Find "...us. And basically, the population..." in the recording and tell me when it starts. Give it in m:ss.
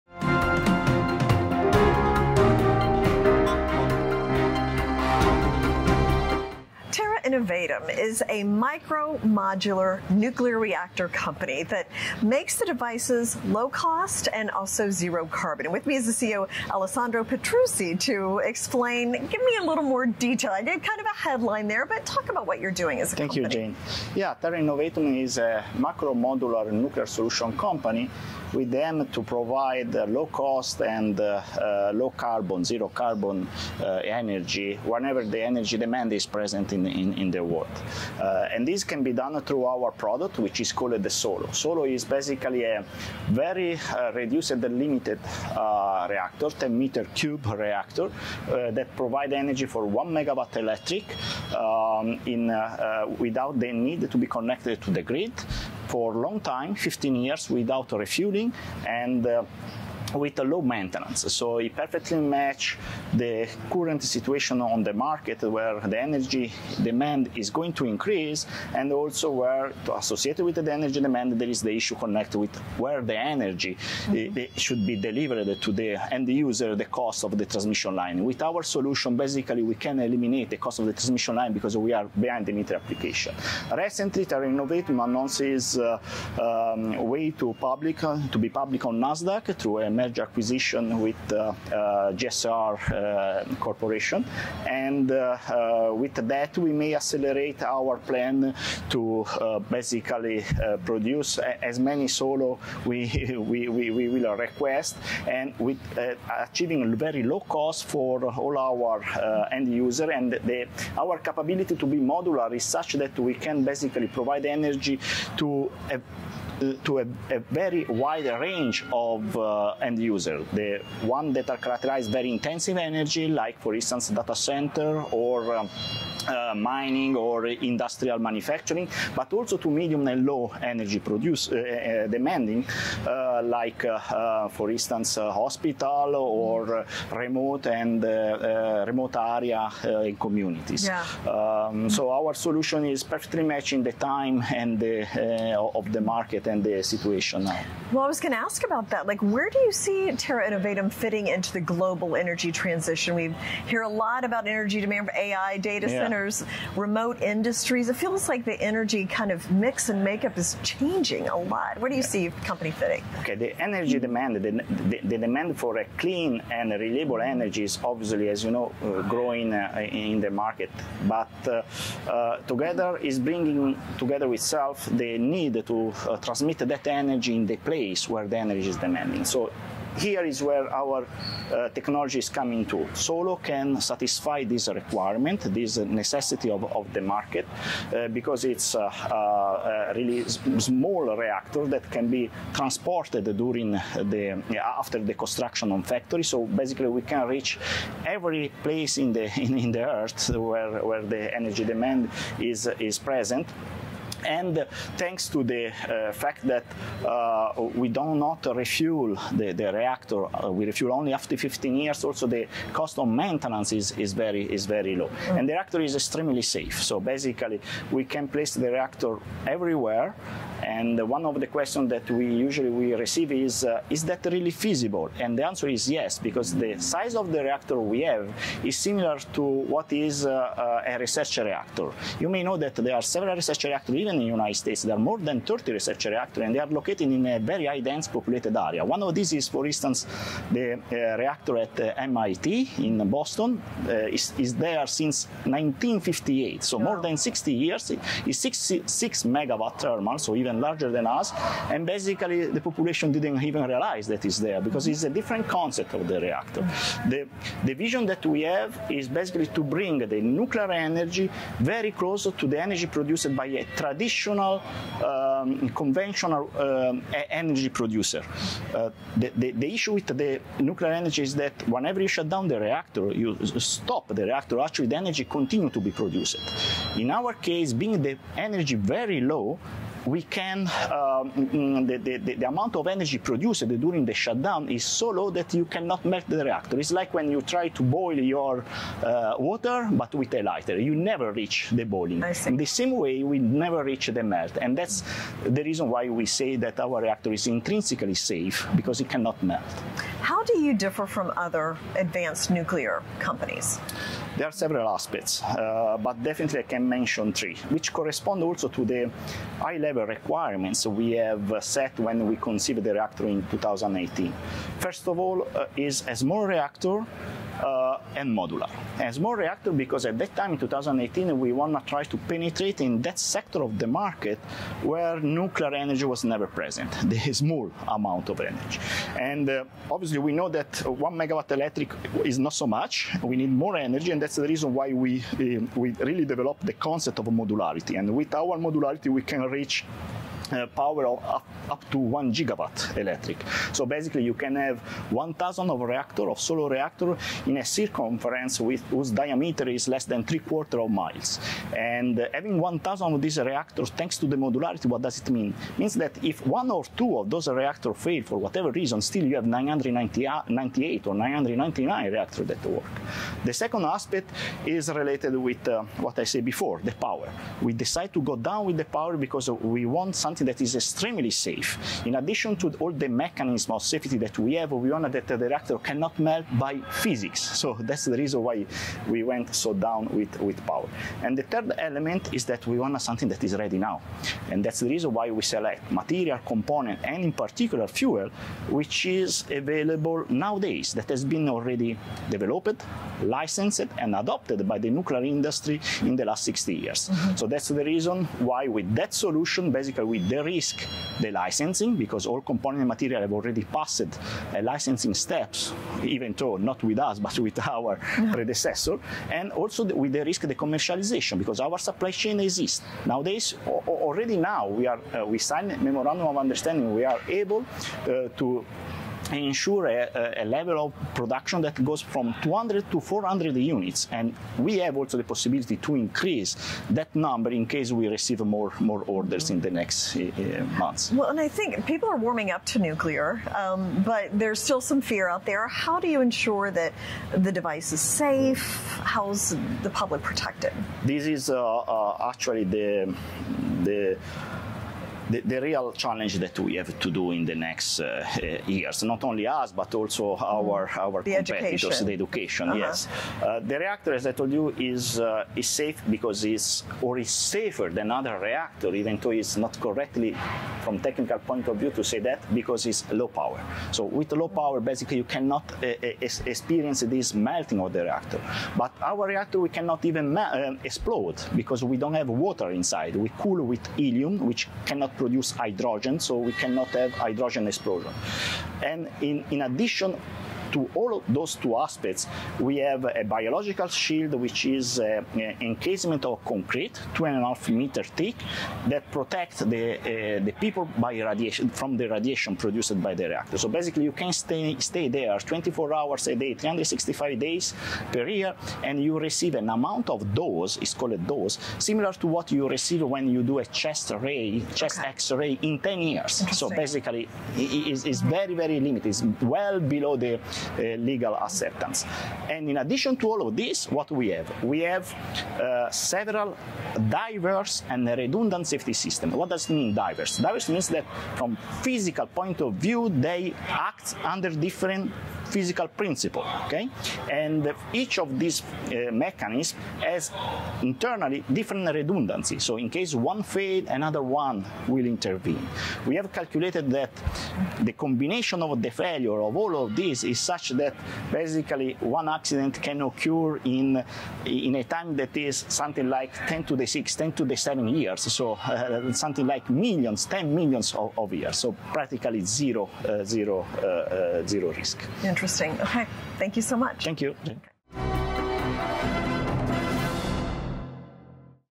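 4:11.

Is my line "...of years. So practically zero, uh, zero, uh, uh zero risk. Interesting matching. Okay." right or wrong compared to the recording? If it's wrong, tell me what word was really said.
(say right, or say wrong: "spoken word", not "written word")
wrong: "interesting", not "matching".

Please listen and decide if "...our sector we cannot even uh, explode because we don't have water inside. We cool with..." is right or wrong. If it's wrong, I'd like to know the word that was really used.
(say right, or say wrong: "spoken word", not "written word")
wrong: "reactor", not "sector".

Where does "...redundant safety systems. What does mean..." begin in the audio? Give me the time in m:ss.
8:38.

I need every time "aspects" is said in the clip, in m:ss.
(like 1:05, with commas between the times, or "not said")
5:04, 6:03, 8:01.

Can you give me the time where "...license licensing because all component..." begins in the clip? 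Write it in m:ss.
6:41.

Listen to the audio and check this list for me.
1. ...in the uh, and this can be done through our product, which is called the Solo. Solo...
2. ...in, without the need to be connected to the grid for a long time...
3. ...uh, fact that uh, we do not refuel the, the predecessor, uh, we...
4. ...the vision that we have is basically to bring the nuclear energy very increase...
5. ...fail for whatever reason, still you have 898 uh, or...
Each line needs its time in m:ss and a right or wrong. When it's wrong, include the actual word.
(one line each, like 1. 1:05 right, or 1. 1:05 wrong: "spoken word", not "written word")
1. 0:37 right
2. 0:52 right
3. 3:25 wrong: "reactor", not "predecessor"
4. 4:17 wrong: "close", not "increase"
5. 5:57 wrong: "998", not "898".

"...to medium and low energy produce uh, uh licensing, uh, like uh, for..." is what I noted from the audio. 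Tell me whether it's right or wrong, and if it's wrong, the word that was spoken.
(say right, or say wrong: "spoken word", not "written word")
wrong: "demanding", not "licensing".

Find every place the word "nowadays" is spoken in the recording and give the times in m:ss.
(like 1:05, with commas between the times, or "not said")
6:30, 6:53.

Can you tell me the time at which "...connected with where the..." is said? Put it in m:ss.
1:11.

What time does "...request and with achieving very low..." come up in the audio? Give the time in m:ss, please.
1:44.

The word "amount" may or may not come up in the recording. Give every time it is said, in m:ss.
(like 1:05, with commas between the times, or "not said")
4:42, 5:27, 8:19.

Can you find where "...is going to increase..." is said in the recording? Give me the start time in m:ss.
1:07.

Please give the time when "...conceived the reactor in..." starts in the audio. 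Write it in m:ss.
5:12.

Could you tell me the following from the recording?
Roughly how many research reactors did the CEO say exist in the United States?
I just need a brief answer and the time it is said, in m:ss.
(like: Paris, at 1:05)
More than 30, at 3:54.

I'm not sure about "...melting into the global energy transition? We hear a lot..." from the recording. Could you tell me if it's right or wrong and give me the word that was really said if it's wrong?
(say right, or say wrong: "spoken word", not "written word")
wrong: "fitting", not "melting".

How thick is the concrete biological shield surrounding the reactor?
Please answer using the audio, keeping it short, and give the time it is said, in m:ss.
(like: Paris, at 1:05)
2.5 meters, at 8:07.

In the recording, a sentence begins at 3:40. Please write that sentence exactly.
And one of the questions that we usually we receive is uh, is that really feasible?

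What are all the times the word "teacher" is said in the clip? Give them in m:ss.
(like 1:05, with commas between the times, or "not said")
not said.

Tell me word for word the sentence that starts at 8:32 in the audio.
And in addition to all of this, what we have?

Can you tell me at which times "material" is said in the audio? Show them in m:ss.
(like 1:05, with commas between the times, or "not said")
6:25, 6:42.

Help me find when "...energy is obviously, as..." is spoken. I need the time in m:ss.
2:47.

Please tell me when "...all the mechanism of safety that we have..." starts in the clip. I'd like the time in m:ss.
6:12.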